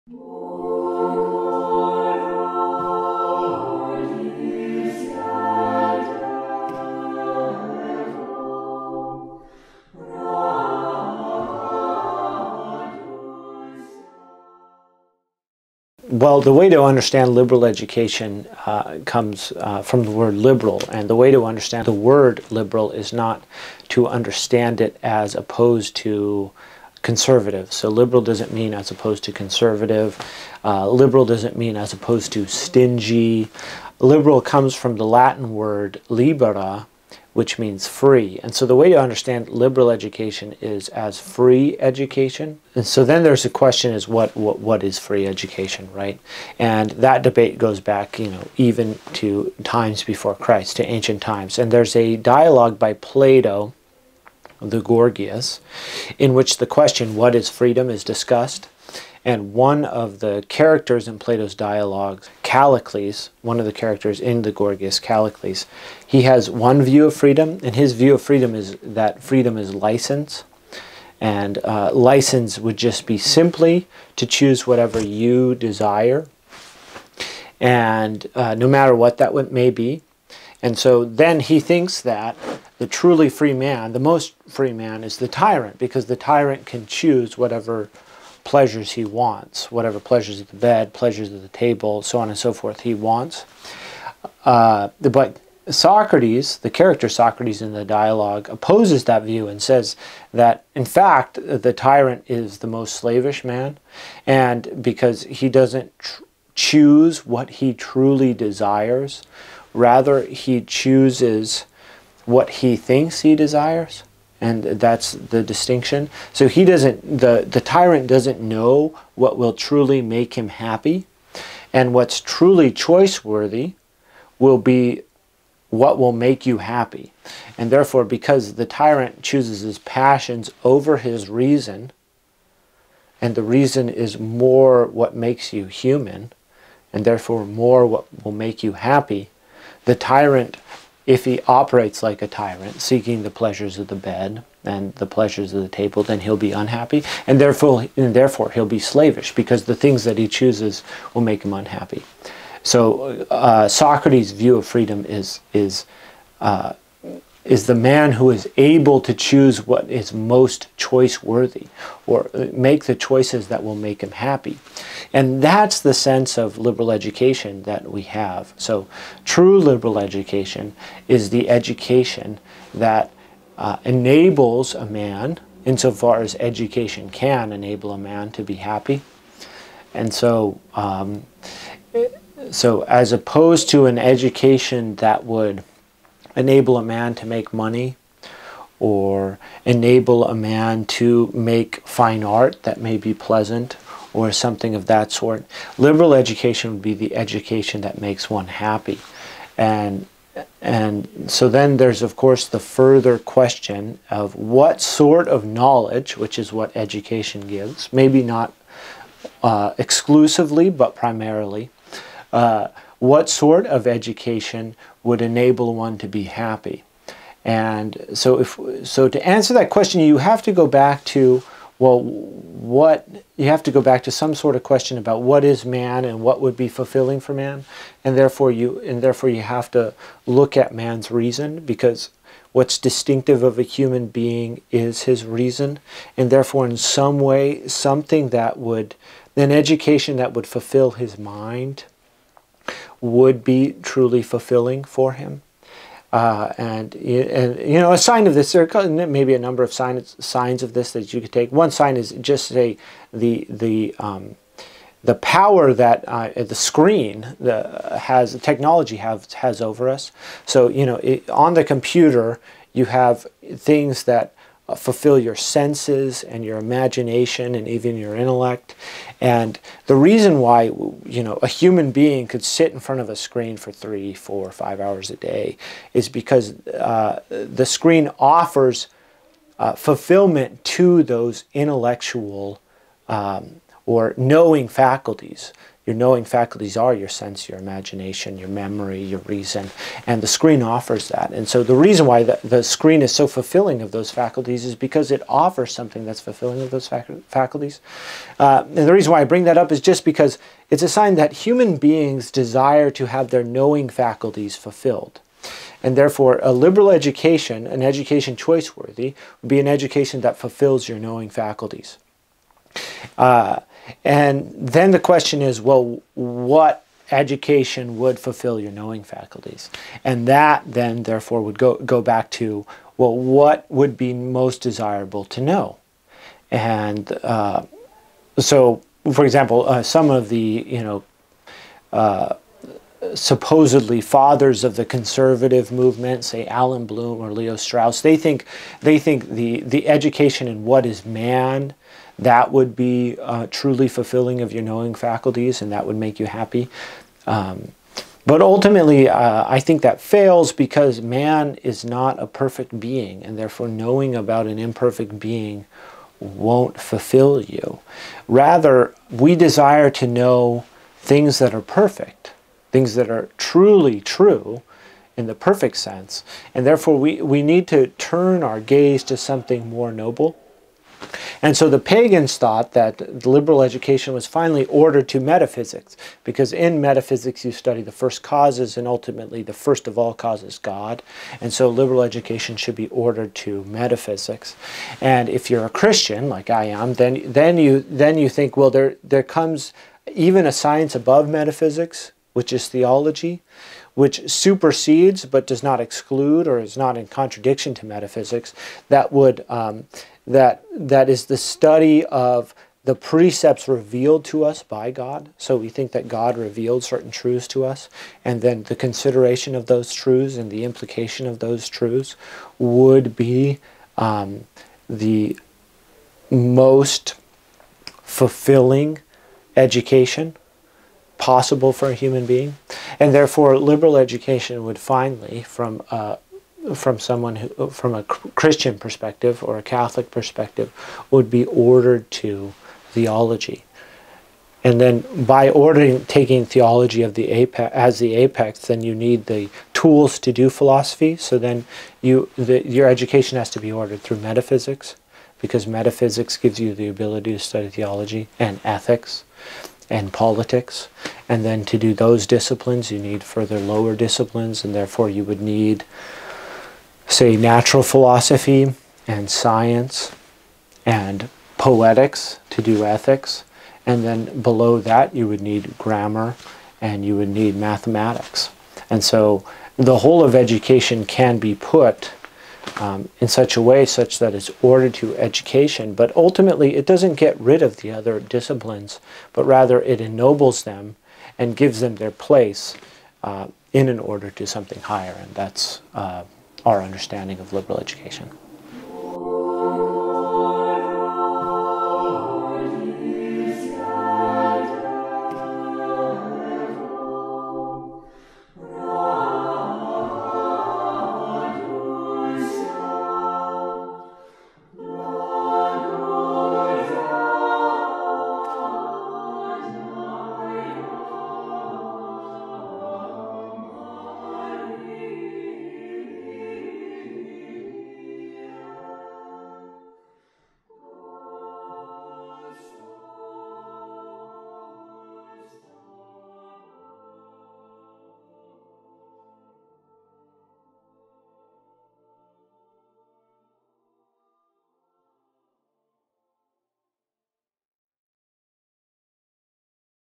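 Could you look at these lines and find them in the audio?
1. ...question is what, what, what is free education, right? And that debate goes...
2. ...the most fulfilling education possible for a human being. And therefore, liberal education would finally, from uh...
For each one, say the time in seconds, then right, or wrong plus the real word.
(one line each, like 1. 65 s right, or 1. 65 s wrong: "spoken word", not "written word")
1. 43 s right
2. 414 s right.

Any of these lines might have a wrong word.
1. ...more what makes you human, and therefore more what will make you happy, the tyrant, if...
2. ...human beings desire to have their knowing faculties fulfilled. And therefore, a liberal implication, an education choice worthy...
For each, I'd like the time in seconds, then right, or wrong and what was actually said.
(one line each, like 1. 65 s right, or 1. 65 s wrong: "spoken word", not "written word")
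1. 134 s right
2. 301 s wrong: "education", not "implication".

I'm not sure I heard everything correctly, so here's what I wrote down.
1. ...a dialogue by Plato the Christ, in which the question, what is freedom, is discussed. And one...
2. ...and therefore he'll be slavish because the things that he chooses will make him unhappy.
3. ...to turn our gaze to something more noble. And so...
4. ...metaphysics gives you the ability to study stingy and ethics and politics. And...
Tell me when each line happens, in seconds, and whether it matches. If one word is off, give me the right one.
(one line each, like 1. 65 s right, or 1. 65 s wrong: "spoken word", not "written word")
1. 51 s wrong: "Gorgias", not "Christ"
2. 147 s right
3. 367 s right
4. 445 s wrong: "theology", not "stingy".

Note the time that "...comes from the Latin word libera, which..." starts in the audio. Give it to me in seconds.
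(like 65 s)
34 s.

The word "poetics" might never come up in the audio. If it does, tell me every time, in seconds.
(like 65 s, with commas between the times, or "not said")
461 s.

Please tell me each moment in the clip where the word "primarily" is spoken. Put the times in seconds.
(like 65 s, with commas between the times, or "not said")
210 s.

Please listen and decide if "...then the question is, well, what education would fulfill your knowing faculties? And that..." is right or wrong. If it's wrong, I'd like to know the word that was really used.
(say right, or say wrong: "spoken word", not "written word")
right.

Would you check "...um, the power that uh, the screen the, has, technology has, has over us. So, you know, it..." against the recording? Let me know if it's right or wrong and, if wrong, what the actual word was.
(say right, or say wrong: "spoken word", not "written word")
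right.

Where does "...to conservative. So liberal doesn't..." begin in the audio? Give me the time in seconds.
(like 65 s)
25 s.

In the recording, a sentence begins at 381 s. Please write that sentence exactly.
And so liberal education should be ordered to metaphysics.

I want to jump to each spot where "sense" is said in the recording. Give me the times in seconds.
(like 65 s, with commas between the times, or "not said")
165 s, 265 s, 287 s, 365 s.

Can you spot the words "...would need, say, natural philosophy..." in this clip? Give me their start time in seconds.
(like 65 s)
455 s.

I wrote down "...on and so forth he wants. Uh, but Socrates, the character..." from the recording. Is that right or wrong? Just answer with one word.
right.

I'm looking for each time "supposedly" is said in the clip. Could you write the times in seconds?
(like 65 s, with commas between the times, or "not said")
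333 s.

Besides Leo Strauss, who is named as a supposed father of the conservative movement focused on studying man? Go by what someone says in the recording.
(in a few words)
Allan Bloom.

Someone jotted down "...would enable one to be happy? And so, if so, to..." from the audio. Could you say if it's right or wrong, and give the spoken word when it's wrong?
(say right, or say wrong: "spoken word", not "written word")
right.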